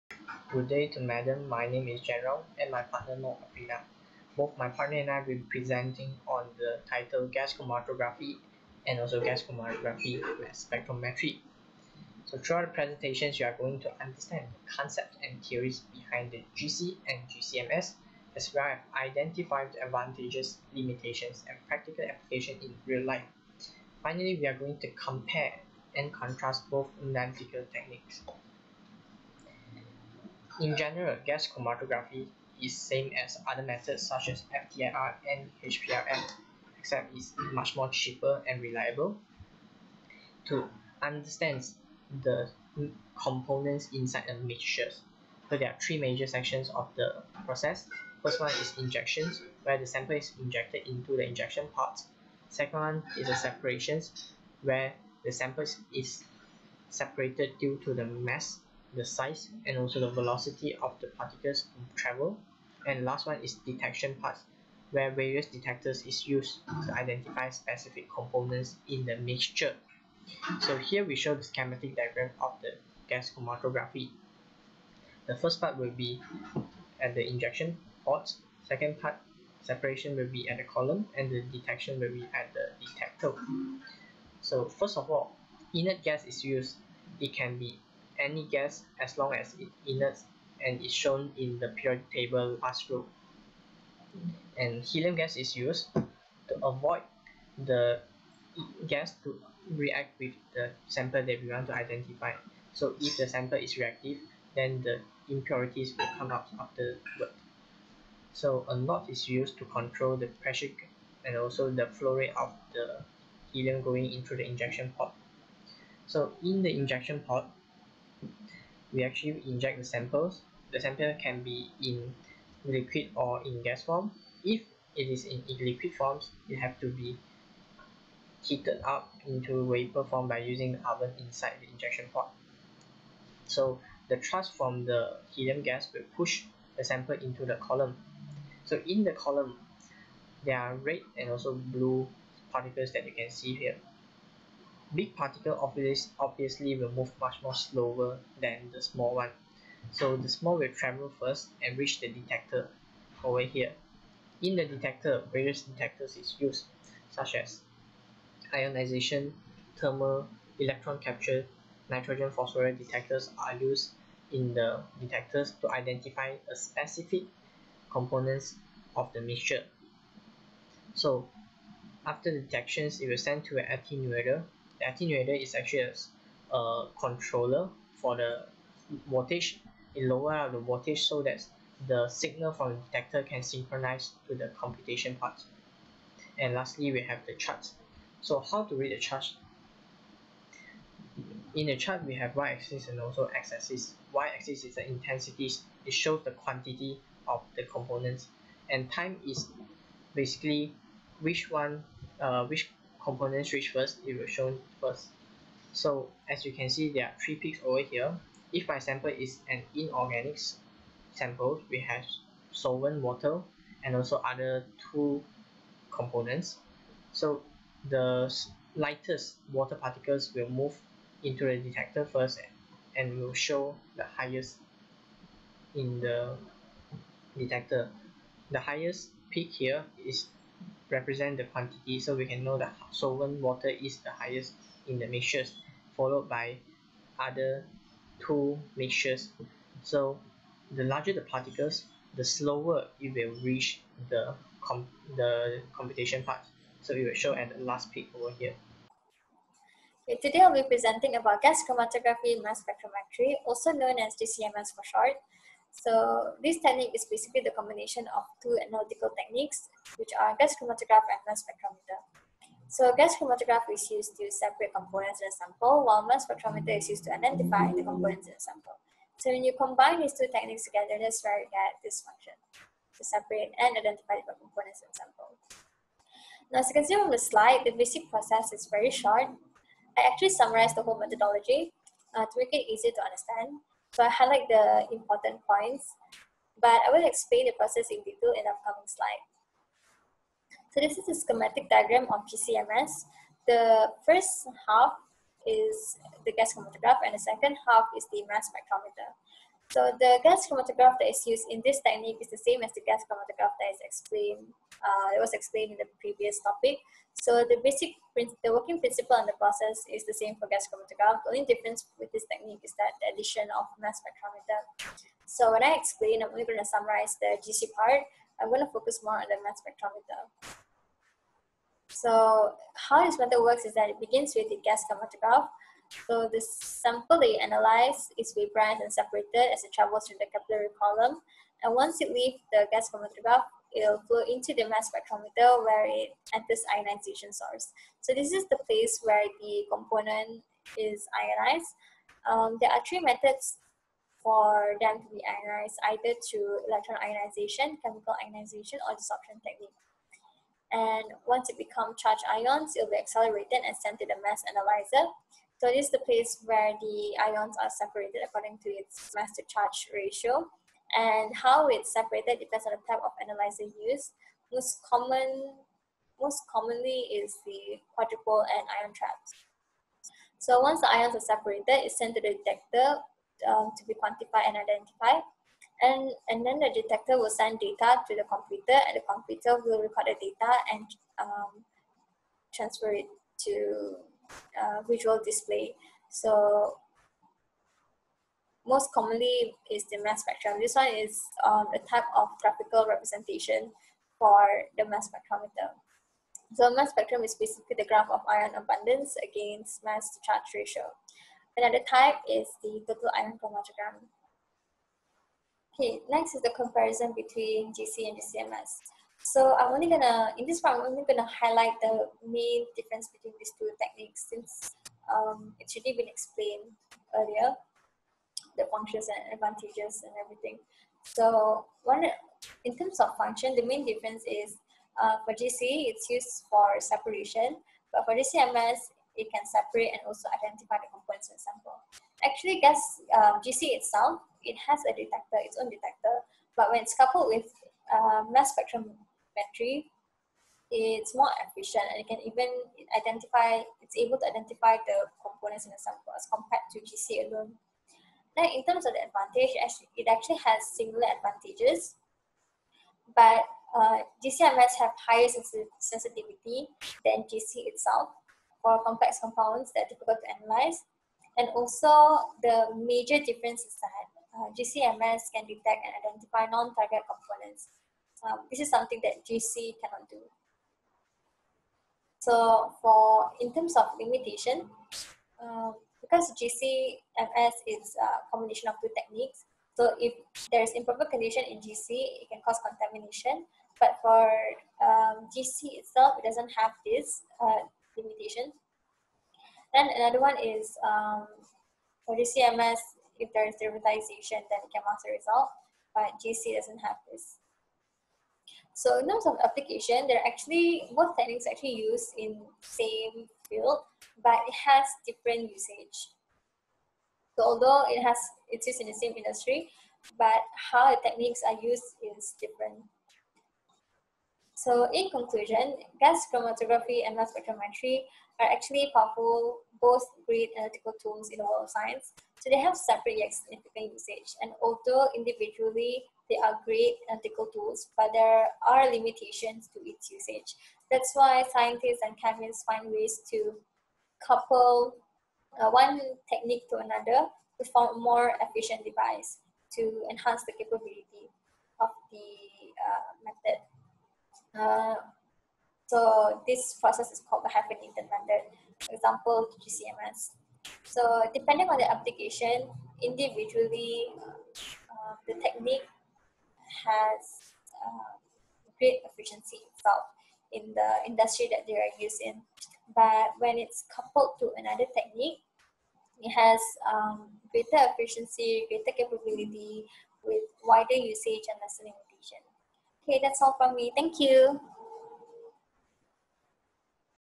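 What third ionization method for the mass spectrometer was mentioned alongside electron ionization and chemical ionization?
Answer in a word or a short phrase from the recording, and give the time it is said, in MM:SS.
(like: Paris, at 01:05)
Desorption technique, at 05:48.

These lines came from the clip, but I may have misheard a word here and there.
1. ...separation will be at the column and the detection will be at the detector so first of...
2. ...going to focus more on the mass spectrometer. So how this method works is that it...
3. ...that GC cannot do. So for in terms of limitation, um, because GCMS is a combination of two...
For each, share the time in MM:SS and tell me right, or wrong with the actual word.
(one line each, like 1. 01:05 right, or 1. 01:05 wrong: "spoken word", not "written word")
1. 01:19 right
2. 05:18 right
3. 07:49 right.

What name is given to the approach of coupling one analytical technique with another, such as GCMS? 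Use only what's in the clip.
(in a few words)
Hyphenated method.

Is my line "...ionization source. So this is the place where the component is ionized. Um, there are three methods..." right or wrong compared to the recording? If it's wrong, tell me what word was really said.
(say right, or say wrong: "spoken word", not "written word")
right.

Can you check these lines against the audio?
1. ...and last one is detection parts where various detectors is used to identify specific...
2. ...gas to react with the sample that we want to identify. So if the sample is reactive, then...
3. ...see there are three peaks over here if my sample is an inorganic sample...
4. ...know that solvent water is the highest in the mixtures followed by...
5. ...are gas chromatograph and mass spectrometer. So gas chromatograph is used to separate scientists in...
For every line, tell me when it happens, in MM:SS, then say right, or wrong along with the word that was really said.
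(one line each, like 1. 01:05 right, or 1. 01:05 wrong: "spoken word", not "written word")
1. 01:02 right
2. 01:38 right
3. 03:26 right
4. 03:52 right
5. 04:20 wrong: "components", not "scientists".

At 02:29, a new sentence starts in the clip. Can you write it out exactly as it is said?
So the small will travel first and reach the detector over here.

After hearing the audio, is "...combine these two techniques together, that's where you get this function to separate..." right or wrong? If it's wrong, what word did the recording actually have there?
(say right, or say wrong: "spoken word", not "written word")
right.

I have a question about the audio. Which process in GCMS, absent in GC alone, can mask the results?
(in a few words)
Derivatization.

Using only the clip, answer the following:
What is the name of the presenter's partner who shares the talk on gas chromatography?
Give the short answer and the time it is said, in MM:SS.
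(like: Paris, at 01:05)
Afrina, at 00:03.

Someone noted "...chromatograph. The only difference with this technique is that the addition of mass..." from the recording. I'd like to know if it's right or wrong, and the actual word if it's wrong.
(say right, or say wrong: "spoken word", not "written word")
right.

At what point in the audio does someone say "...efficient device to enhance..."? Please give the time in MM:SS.
08:58.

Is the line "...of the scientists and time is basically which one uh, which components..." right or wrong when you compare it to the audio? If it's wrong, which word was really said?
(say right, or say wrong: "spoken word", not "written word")
wrong: "components", not "scientists".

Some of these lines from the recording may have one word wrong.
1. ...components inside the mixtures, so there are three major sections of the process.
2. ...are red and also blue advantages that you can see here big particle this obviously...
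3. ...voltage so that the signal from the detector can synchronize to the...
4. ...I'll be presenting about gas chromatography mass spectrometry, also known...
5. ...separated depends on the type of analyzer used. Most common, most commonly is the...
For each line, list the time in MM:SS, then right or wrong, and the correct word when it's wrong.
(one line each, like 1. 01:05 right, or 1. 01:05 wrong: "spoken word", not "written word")
1. 00:43 right
2. 02:20 wrong: "particles", not "advantages"
3. 03:00 right
4. 04:10 right
5. 06:01 right.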